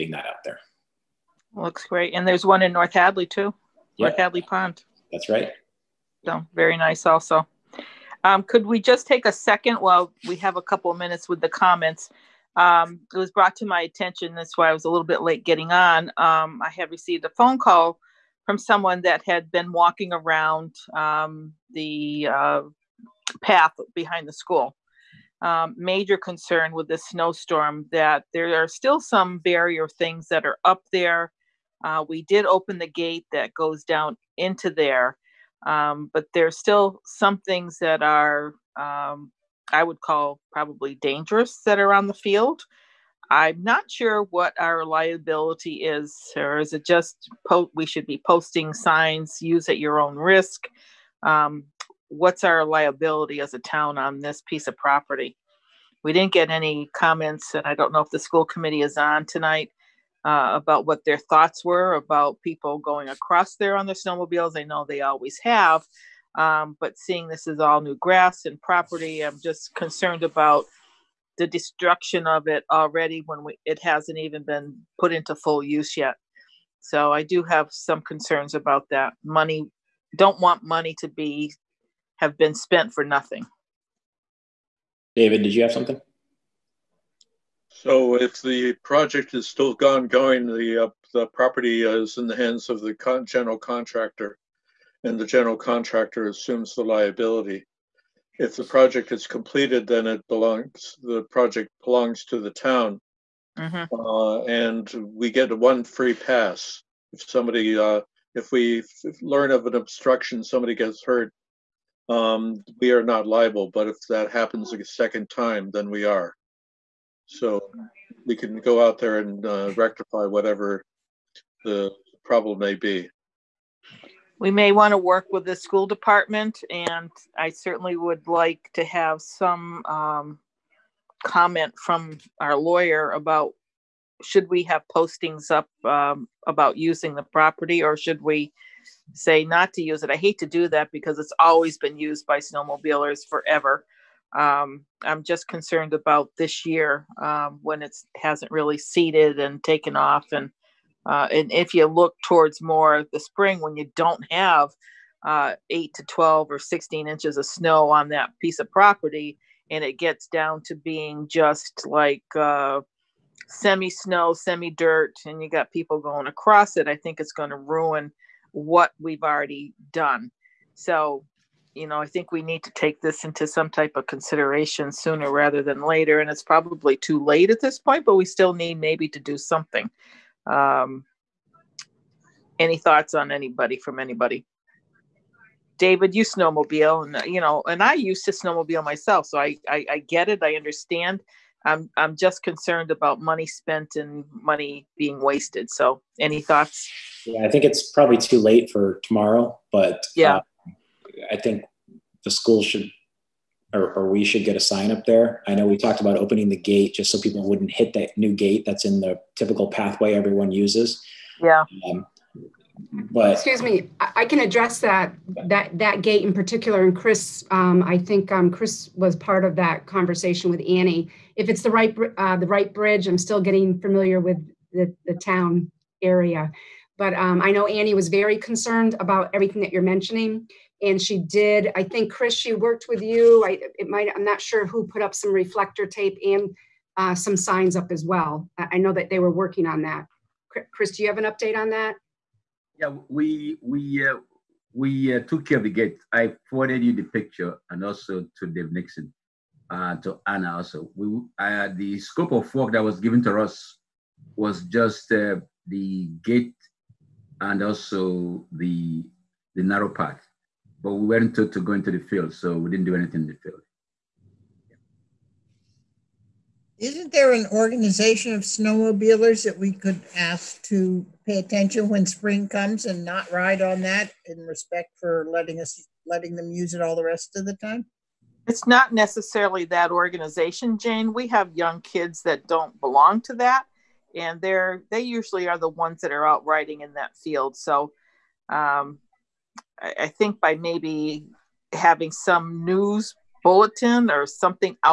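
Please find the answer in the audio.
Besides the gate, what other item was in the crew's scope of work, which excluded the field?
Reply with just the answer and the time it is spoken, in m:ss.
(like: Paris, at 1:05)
the narrow path, at 4:19.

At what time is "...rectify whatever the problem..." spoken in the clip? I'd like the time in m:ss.
1:59.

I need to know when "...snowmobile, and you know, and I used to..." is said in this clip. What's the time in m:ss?
3:06.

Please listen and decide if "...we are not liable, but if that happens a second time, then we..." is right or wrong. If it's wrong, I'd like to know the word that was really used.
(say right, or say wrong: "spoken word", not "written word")
right.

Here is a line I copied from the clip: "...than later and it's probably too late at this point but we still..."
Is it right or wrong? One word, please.
right.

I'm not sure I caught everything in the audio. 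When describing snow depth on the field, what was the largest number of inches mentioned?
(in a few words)
16.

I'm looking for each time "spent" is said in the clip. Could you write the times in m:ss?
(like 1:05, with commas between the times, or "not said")
1:22, 3:13.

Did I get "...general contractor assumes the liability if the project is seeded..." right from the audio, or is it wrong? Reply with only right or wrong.
wrong.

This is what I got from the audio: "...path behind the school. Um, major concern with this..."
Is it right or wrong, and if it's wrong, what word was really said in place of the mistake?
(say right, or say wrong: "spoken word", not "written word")
right.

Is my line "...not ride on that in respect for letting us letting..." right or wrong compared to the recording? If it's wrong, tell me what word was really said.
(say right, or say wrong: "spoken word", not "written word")
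right.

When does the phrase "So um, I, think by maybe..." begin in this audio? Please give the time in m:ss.
4:47.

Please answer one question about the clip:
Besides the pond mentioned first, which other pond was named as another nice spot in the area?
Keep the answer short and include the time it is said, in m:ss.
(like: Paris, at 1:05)
North Hadley Pond, at 0:03.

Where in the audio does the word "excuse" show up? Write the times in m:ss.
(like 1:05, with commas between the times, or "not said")
3:33.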